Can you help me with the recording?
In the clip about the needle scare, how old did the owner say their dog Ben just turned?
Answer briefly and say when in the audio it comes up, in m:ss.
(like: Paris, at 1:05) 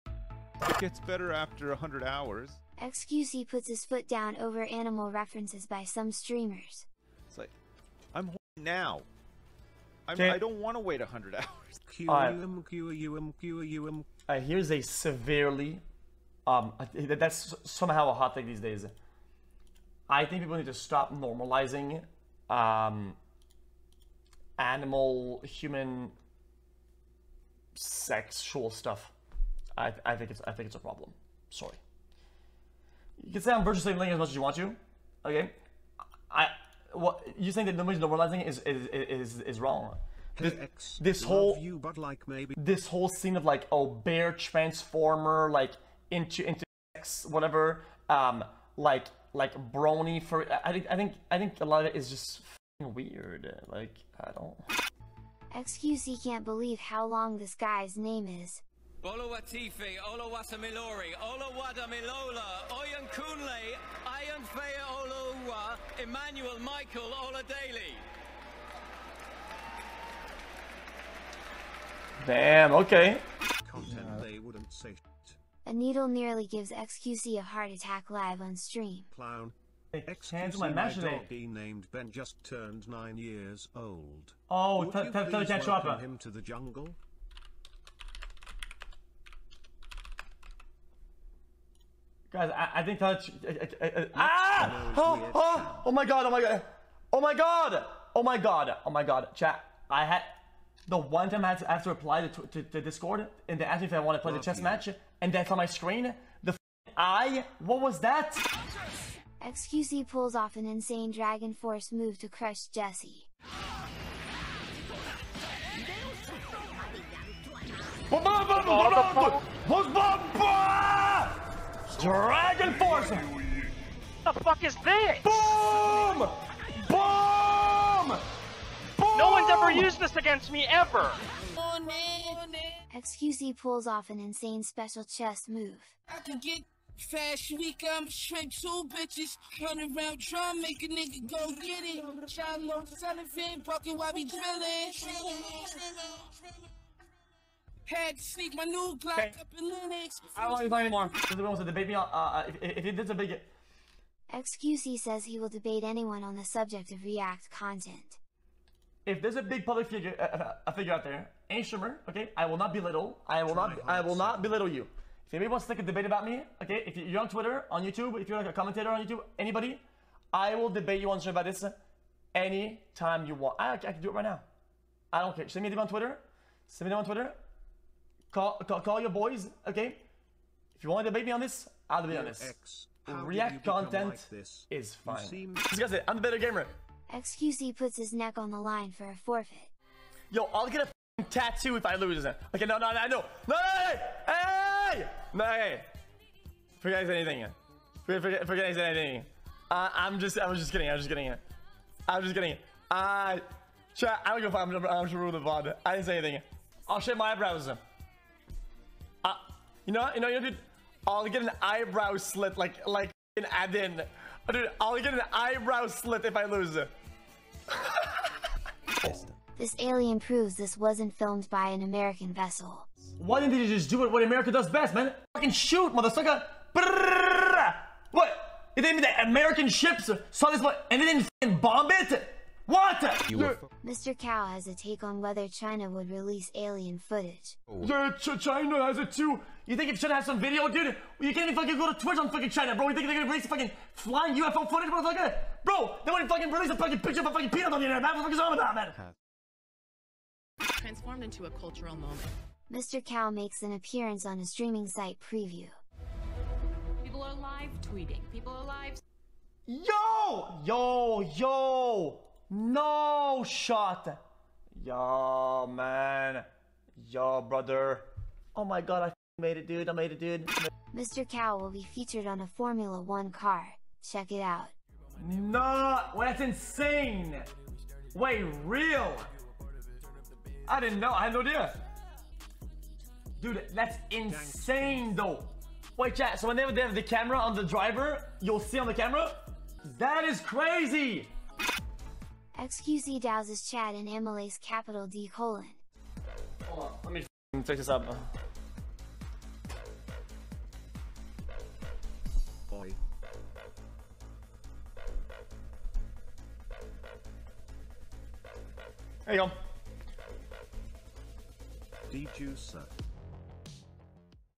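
9, at 1:22.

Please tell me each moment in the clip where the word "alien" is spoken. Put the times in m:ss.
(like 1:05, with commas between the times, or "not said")
3:39, 3:56.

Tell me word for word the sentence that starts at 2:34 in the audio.
XQC says he will debate anyone on the subject of React content.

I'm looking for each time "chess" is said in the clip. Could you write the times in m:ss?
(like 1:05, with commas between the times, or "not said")
1:44, 2:15.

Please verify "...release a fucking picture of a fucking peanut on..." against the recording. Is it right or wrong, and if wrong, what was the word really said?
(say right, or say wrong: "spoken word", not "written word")
right.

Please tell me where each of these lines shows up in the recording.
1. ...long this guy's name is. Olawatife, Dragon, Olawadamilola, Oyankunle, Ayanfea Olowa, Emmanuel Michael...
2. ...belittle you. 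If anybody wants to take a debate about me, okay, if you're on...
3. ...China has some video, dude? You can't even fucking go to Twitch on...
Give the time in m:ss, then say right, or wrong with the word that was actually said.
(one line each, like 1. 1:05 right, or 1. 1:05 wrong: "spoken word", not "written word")
1. 0:57 wrong: "Olawatamilori", not "Dragon"
2. 2:44 right
3. 3:59 right.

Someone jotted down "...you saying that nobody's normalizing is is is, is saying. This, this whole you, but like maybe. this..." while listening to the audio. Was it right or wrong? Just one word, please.
wrong.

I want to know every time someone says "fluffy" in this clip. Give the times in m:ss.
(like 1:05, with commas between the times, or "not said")
not said.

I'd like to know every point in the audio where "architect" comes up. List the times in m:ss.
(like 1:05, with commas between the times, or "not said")
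not said.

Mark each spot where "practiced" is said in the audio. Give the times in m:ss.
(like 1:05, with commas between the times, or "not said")
not said.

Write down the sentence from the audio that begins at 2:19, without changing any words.
Run around make a nigga go get it.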